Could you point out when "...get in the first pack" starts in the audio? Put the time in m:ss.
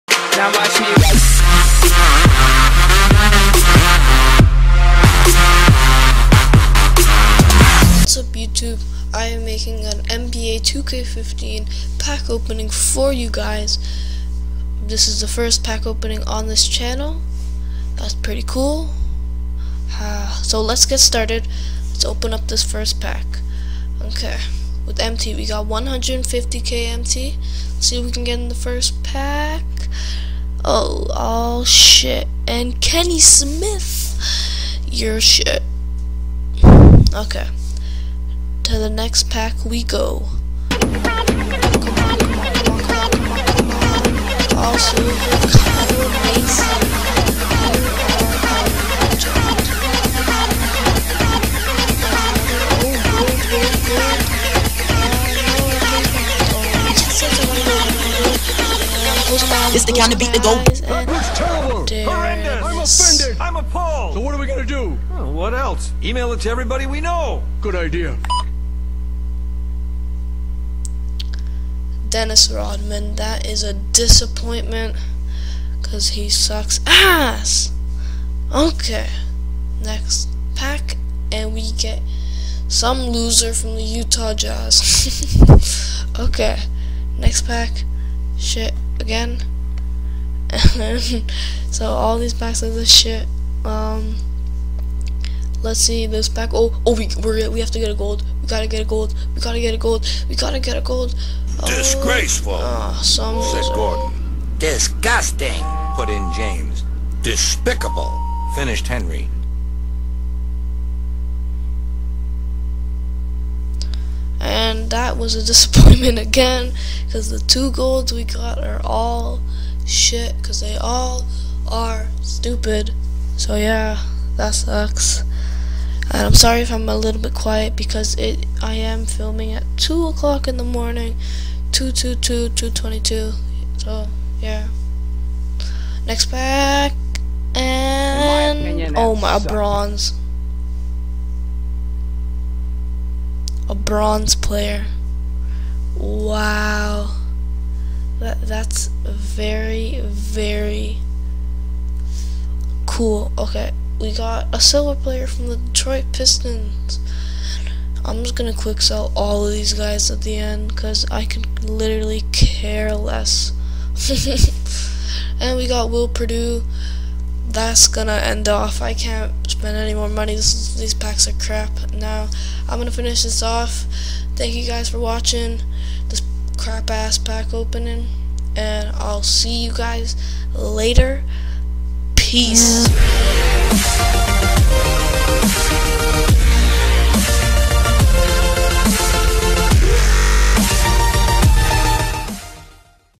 0:28.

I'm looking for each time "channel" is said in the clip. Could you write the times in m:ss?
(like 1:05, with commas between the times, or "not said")
0:16.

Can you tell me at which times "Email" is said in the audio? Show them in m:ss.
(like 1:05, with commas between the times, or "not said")
1:06.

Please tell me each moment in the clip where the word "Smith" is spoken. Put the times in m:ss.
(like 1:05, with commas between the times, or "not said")
0:33.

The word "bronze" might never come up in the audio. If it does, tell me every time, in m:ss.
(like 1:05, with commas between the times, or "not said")
2:19, 2:23.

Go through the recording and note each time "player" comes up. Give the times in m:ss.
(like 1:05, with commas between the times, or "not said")
2:24, 2:35.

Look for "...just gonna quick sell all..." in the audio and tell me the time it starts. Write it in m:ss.
2:38.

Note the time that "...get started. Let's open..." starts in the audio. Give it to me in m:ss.
0:20.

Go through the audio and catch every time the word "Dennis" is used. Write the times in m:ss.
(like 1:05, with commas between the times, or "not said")
1:12.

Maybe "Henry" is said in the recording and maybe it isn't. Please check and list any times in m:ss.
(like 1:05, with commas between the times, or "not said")
1:48.